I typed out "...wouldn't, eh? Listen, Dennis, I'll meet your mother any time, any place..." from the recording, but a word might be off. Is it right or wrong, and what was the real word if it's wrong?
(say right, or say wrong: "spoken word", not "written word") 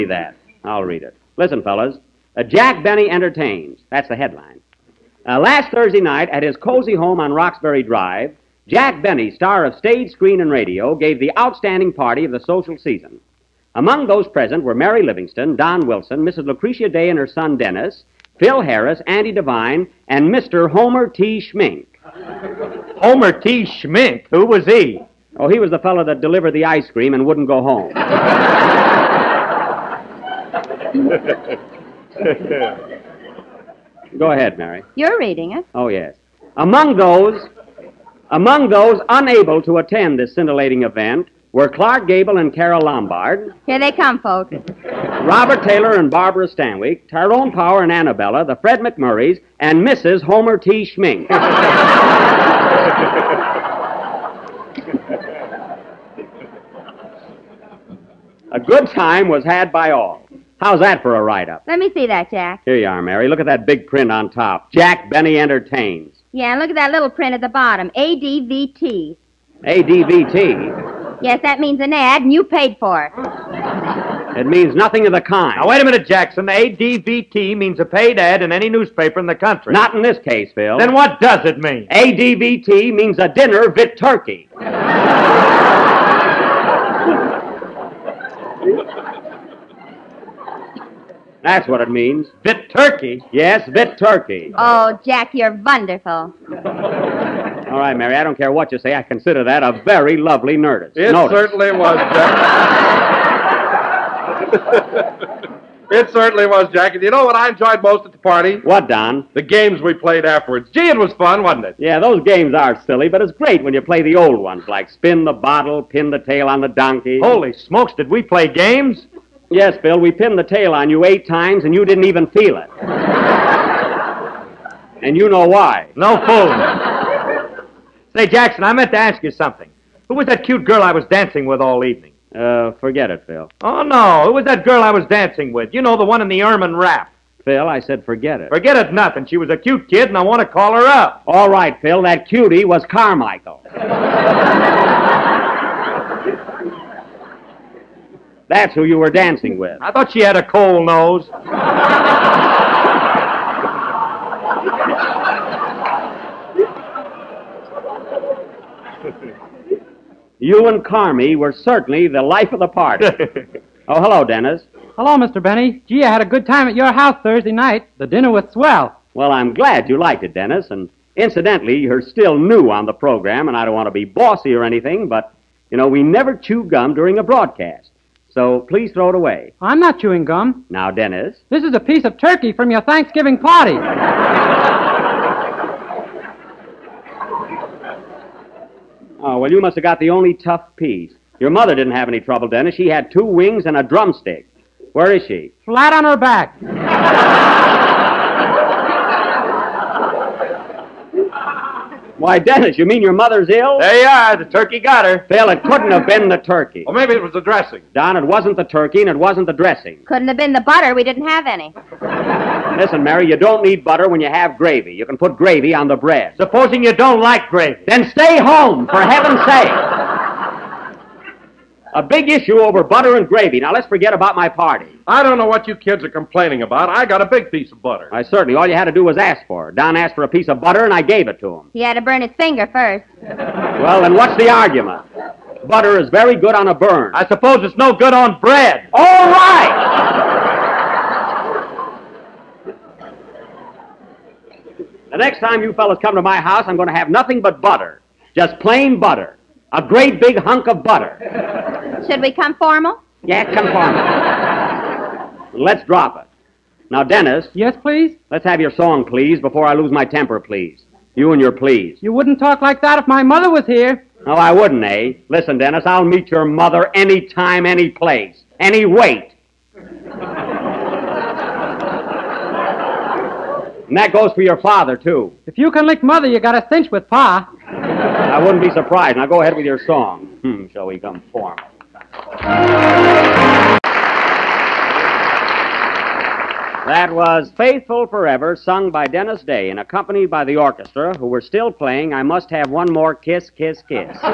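right.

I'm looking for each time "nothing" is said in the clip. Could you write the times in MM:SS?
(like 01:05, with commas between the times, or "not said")
01:14, 02:18, 04:07.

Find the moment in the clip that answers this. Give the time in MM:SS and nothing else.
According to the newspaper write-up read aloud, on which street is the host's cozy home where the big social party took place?
00:07.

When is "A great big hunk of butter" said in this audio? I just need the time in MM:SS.
04:09.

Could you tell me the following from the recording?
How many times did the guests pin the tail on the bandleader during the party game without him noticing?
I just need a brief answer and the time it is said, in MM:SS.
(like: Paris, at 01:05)
8, at 02:01.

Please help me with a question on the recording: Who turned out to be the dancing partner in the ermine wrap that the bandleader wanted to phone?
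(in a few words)
Carmichael.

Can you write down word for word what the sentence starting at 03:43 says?
Now, let's forget about my party.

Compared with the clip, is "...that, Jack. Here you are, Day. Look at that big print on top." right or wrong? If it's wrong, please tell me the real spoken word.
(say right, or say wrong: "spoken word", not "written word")
wrong: "Mary", not "Day".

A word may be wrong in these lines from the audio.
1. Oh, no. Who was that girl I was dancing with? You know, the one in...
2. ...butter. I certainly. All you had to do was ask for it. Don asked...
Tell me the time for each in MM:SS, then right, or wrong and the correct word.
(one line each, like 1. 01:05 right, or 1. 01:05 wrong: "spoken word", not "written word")
1. 02:13 right
2. 03:47 right.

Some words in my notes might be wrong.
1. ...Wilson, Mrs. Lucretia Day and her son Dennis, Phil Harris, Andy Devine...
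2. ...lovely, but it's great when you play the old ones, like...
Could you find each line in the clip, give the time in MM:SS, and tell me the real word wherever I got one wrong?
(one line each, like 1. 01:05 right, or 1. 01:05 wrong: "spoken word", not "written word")
1. 00:15 right
2. 01:52 wrong: "silly", not "lovely".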